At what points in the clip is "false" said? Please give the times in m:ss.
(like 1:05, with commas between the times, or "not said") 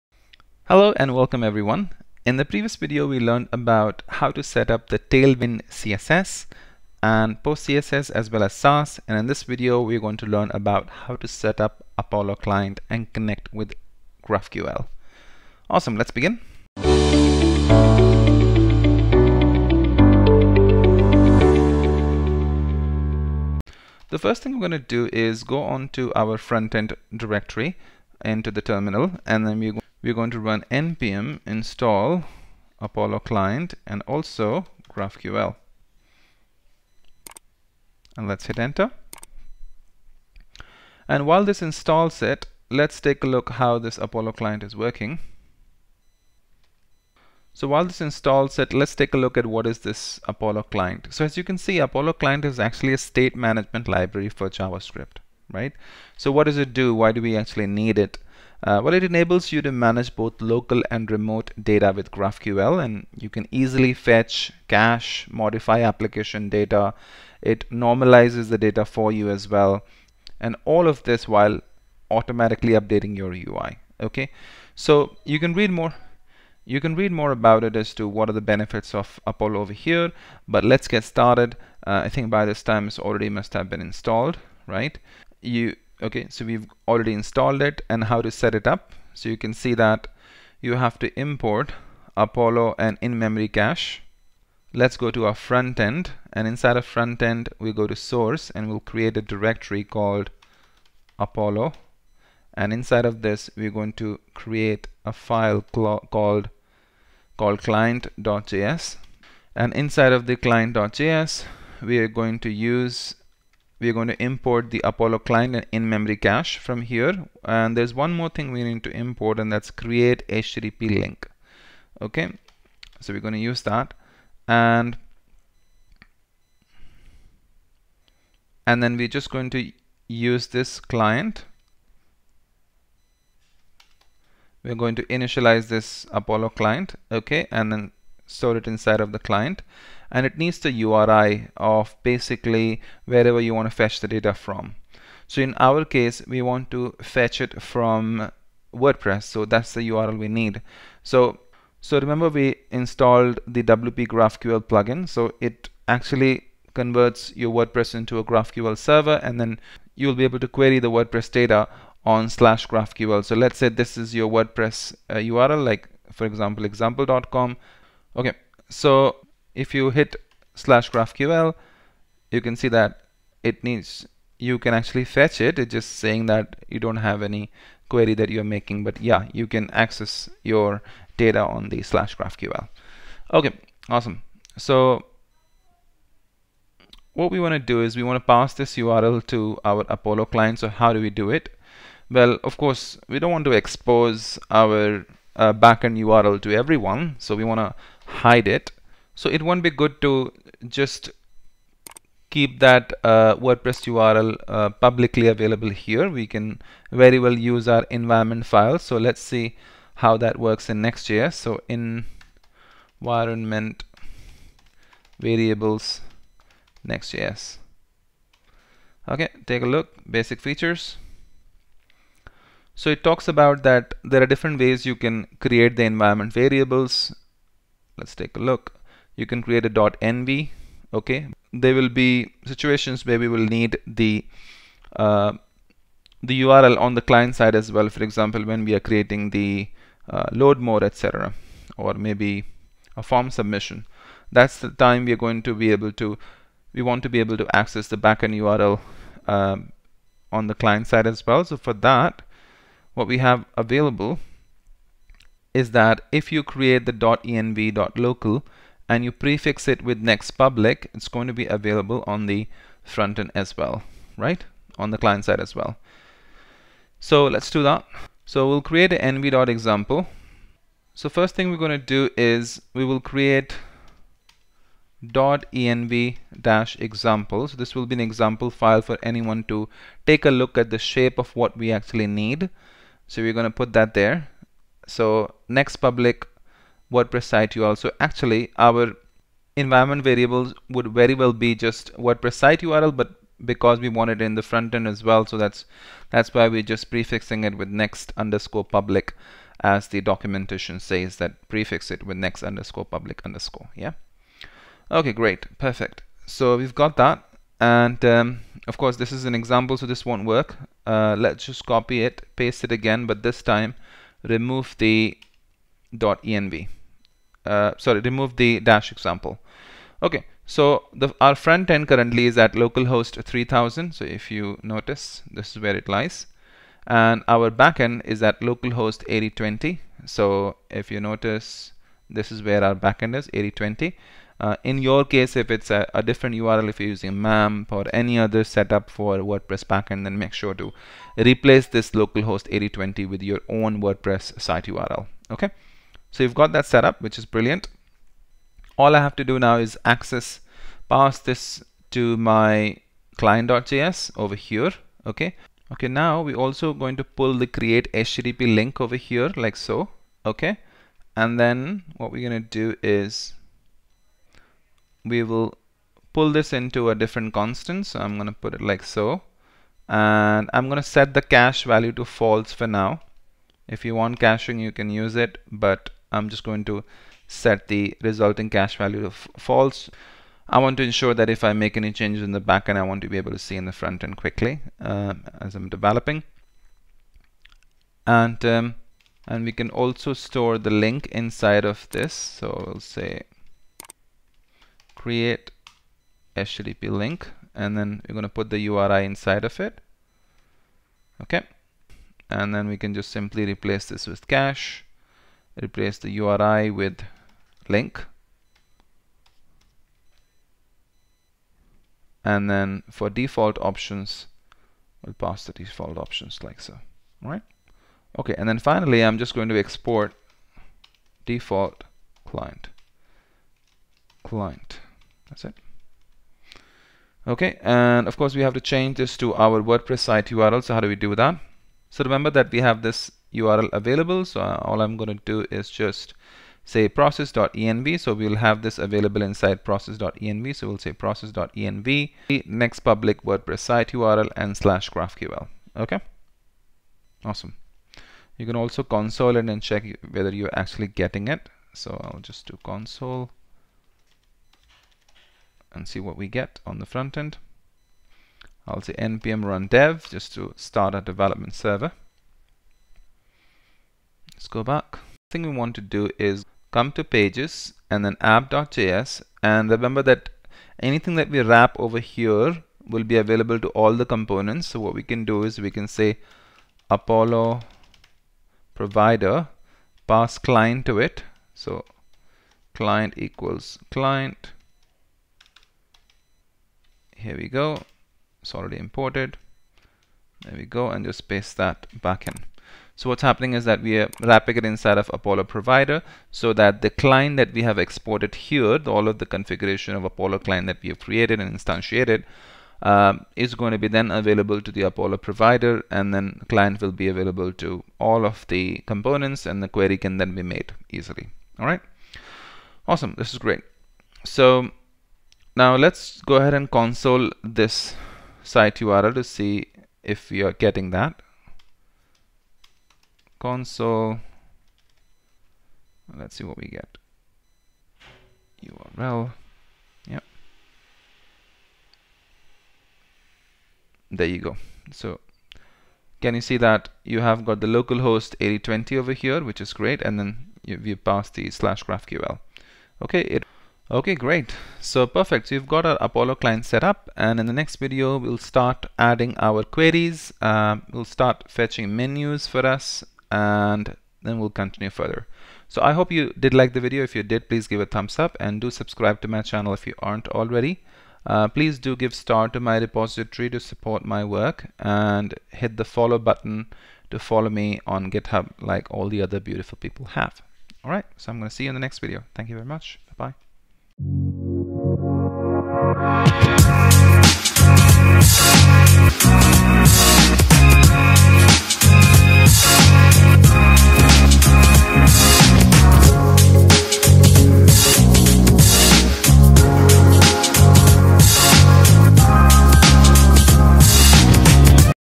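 6:12, 6:19.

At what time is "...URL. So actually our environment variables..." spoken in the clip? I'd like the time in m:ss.
4:47.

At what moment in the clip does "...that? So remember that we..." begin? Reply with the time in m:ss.
7:11.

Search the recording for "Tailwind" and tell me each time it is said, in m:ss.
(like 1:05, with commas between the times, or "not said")
0:04.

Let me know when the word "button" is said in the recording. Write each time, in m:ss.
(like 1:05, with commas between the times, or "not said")
9:26.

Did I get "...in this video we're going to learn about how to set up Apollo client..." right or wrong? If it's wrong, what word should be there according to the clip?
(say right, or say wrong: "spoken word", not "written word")
right.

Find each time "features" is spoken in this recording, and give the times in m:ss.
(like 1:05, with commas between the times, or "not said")
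3:40.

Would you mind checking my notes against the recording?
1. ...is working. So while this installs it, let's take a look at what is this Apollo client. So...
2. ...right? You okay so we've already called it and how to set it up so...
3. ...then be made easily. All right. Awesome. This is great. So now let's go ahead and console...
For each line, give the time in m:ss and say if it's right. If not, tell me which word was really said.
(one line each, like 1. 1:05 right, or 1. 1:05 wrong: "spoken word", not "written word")
1. 0:44 right
2. 1:24 wrong: "installed", not "called"
3. 8:30 right.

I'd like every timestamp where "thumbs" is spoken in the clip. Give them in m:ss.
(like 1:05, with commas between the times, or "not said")
9:17.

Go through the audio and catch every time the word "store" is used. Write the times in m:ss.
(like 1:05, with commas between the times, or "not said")
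2:18, 6:30.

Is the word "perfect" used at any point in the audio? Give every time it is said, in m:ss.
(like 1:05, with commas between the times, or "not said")
5:05, 9:05.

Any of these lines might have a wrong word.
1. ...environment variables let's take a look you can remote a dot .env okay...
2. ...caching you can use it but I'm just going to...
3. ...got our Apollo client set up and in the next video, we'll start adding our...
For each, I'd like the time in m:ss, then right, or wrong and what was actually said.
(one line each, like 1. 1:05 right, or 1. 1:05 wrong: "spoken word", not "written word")
1. 3:45 wrong: "create", not "remote"
2. 6:14 right
3. 9:05 right.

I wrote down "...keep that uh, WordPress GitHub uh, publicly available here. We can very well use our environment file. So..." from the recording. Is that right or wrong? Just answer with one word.
wrong.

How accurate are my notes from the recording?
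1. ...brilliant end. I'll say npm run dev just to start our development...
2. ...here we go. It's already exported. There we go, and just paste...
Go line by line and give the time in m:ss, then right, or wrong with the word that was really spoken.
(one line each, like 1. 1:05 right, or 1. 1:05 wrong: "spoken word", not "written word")
1. 7:36 wrong: "front", not "brilliant"
2. 8:07 wrong: "imported", not "exported".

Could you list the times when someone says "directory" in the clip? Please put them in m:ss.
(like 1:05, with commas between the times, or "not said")
0:27, 1:39.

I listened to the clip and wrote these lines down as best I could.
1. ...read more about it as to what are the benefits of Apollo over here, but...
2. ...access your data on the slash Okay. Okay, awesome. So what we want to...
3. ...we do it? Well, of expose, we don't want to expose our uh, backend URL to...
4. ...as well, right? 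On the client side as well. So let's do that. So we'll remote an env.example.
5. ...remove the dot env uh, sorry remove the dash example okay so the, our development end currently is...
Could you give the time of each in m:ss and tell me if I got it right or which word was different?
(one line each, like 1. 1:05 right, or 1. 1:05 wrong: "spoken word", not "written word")
1. 1:16 right
2. 2:59 wrong: "GraphQL", not "Okay"
3. 3:11 wrong: "course", not "expose"
4. 4:23 wrong: "create", not "remote"
5. 5:14 wrong: "front", not "development".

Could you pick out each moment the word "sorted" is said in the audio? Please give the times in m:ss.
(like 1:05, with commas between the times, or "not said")
not said.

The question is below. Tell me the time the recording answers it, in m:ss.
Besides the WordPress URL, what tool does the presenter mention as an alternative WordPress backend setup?
5:37.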